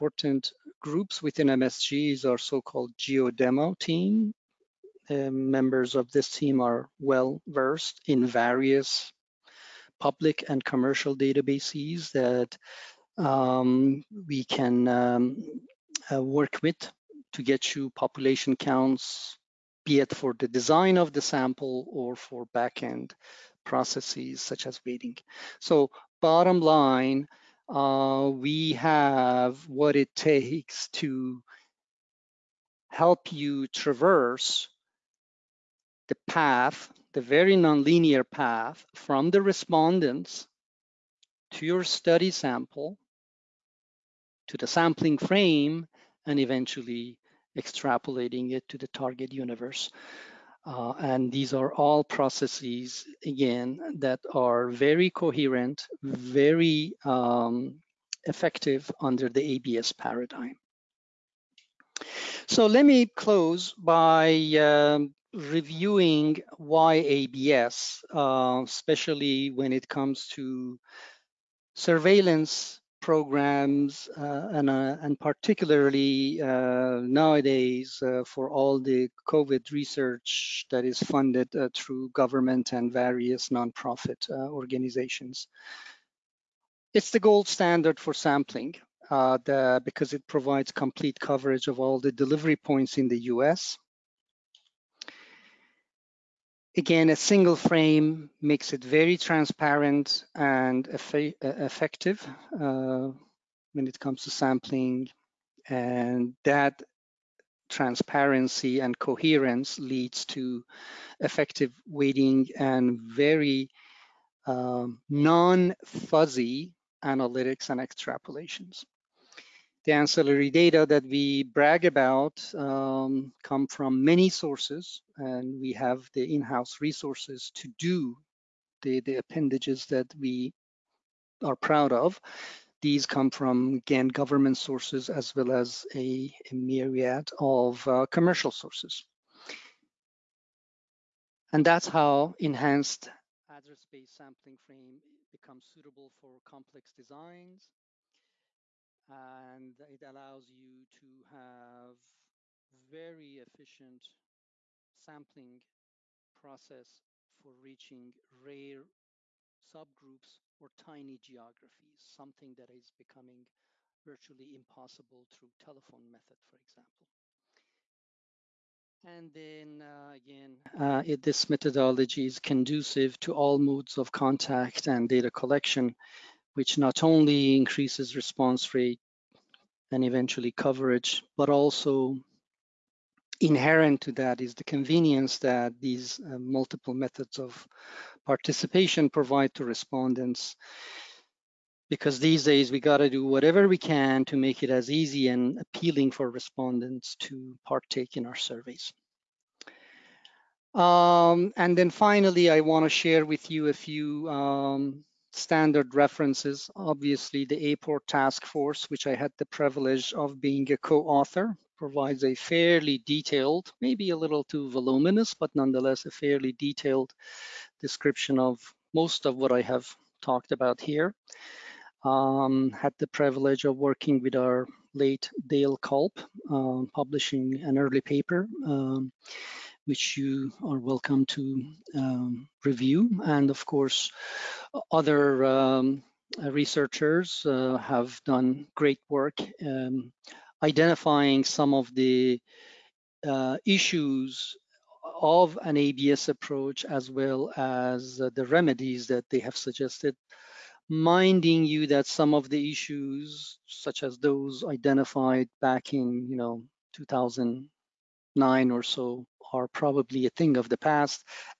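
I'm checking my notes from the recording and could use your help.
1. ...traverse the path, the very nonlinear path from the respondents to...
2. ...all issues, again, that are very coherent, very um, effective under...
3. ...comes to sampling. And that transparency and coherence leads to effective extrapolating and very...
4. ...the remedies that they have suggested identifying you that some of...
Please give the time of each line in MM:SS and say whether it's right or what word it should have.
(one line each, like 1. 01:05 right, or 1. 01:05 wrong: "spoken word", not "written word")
1. 00:33 right
2. 00:51 wrong: "processes", not "issues"
3. 01:43 wrong: "weighting", not "extrapolating"
4. 04:08 wrong: "minding", not "identifying".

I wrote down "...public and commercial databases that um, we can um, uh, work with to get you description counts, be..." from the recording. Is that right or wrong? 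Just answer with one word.
wrong.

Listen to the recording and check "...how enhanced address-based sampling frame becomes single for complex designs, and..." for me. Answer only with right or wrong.
wrong.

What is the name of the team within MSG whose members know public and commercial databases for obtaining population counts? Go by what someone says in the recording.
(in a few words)
geodemo team.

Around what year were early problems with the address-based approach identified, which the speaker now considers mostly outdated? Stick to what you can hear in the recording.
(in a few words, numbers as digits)
2009.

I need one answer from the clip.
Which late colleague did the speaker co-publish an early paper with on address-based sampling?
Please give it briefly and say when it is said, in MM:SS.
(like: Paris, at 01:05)
Dale Kulp, at 03:45.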